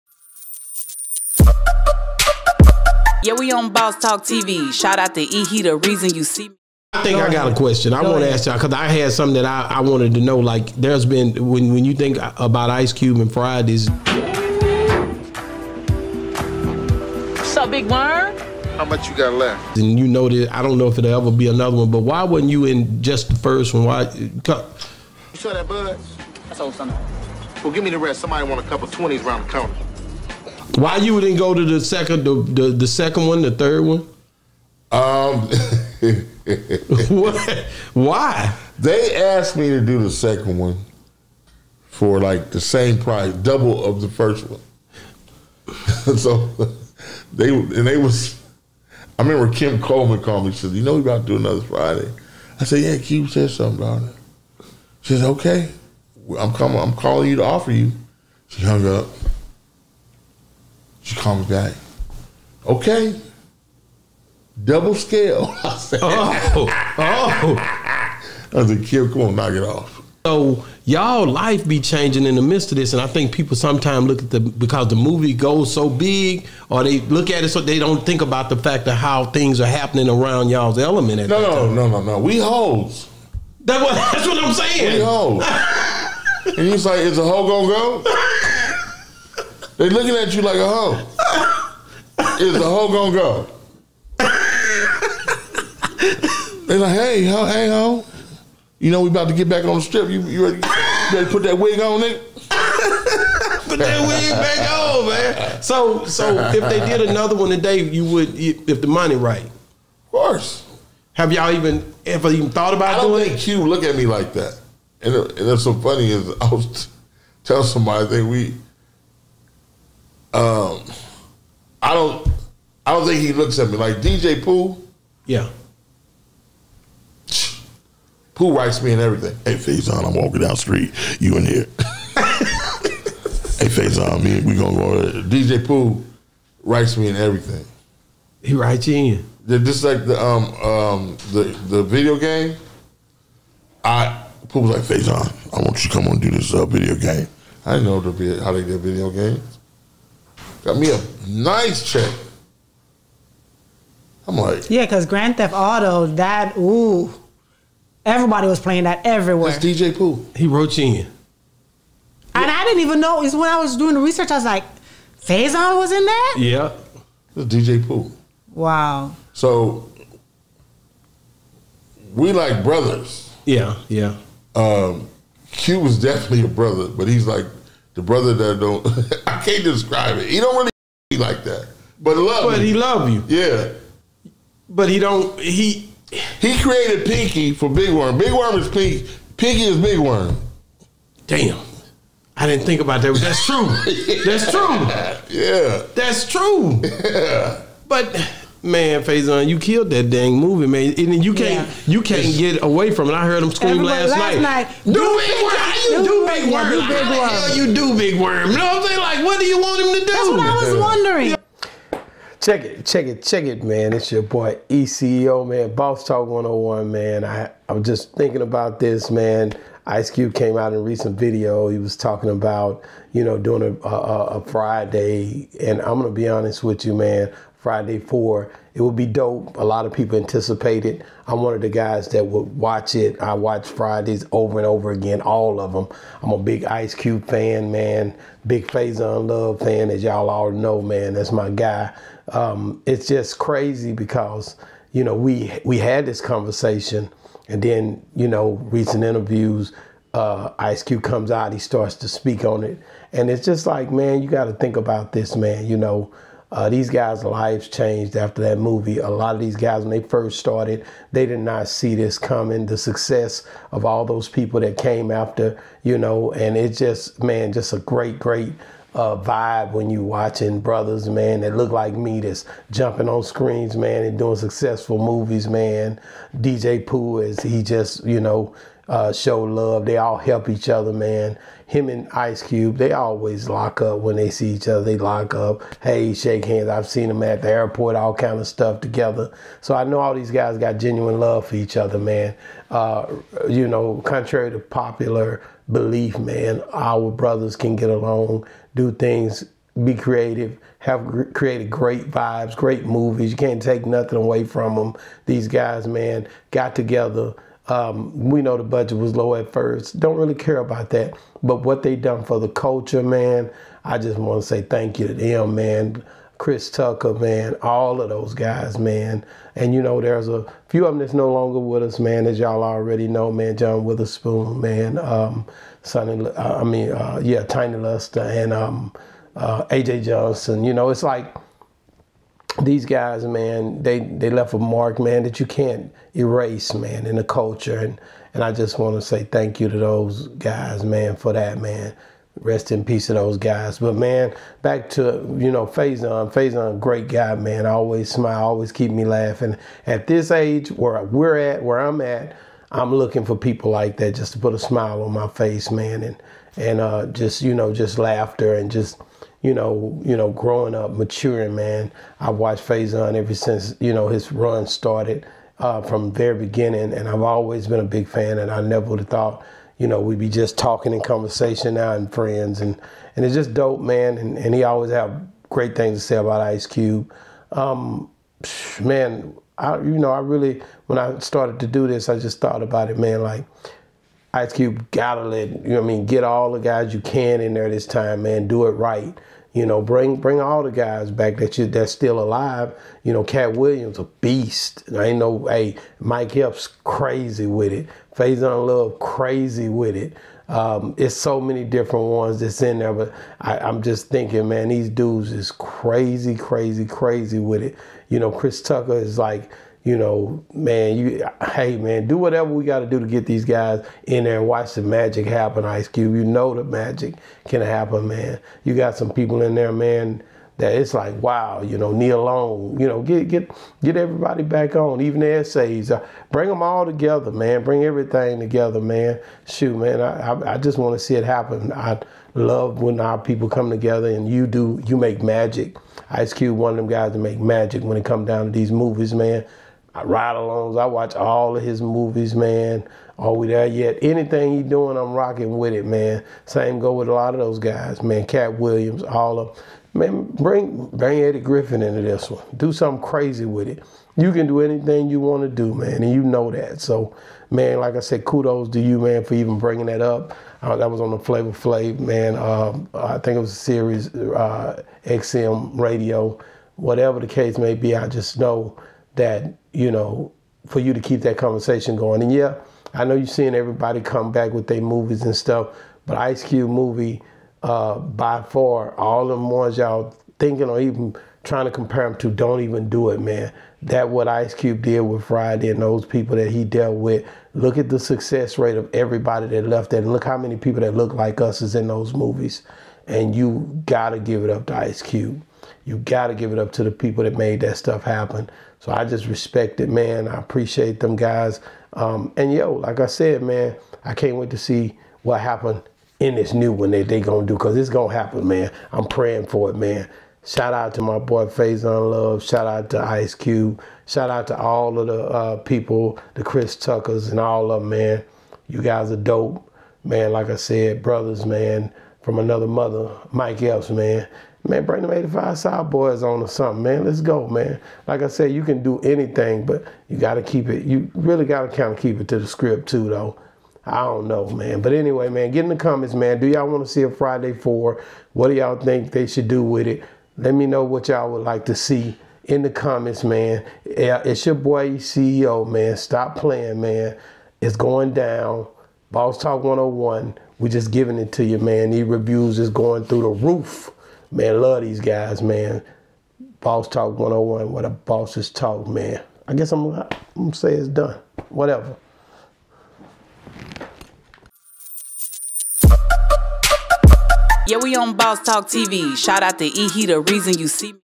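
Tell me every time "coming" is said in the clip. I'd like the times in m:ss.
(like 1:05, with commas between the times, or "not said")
0:56, 4:22.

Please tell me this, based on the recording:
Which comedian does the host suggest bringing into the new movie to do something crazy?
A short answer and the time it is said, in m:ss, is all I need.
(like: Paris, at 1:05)
Eddie Griffin, at 7:31.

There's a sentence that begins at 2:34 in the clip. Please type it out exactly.
I'm like, yeah, because Grand Theft Auto, that ooh, everybody was playing that everywhere.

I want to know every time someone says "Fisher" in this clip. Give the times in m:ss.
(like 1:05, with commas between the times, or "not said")
not said.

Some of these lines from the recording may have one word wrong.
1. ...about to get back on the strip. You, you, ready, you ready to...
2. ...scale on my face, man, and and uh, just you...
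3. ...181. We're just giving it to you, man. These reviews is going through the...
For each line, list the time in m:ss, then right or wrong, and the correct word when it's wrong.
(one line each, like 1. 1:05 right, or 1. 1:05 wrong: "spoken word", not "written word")
1. 1:39 right
2. 5:54 wrong: "smile", not "scale"
3. 9:09 wrong: "101", not "181".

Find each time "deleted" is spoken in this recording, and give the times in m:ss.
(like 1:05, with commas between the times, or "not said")
not said.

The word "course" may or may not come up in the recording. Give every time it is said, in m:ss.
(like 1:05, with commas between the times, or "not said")
1:50.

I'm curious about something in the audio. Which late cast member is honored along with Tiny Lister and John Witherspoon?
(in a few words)
AJ Johnson.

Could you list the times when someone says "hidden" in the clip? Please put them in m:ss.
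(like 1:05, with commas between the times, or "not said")
not said.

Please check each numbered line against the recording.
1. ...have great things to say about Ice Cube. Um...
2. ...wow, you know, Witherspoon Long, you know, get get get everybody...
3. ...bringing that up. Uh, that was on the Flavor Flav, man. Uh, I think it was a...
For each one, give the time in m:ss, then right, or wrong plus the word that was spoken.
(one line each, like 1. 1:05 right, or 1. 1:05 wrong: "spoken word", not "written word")
1. 6:14 right
2. 7:01 wrong: "Nia", not "Witherspoon"
3. 7:39 right.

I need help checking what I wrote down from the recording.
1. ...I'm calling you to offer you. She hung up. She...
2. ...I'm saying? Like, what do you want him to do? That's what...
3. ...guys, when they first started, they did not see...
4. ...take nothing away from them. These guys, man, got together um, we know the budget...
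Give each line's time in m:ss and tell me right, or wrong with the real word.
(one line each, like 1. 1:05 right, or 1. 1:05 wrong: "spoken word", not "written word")
1. 0:56 right
2. 3:28 right
3. 4:19 right
4. 5:03 right.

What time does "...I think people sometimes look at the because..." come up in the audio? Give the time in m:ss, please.
1:13.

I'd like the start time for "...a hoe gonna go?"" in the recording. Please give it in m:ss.
1:27.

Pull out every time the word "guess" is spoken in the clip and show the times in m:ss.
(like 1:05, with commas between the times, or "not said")
9:19.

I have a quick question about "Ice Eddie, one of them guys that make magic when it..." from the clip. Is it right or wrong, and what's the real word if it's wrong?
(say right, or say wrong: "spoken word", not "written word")
wrong: "Cube", not "Eddie".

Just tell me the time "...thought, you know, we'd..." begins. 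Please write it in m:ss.
6:09.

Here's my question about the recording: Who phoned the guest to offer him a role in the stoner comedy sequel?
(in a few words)
Kim Coleman.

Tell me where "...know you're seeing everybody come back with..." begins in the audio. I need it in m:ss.
7:53.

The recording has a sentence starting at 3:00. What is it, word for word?
He don't want to like that, but love.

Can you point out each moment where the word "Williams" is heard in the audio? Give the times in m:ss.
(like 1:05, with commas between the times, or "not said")
6:33, 7:28.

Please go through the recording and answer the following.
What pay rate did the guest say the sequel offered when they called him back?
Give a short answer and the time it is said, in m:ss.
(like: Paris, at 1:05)
Double scale, at 1:04.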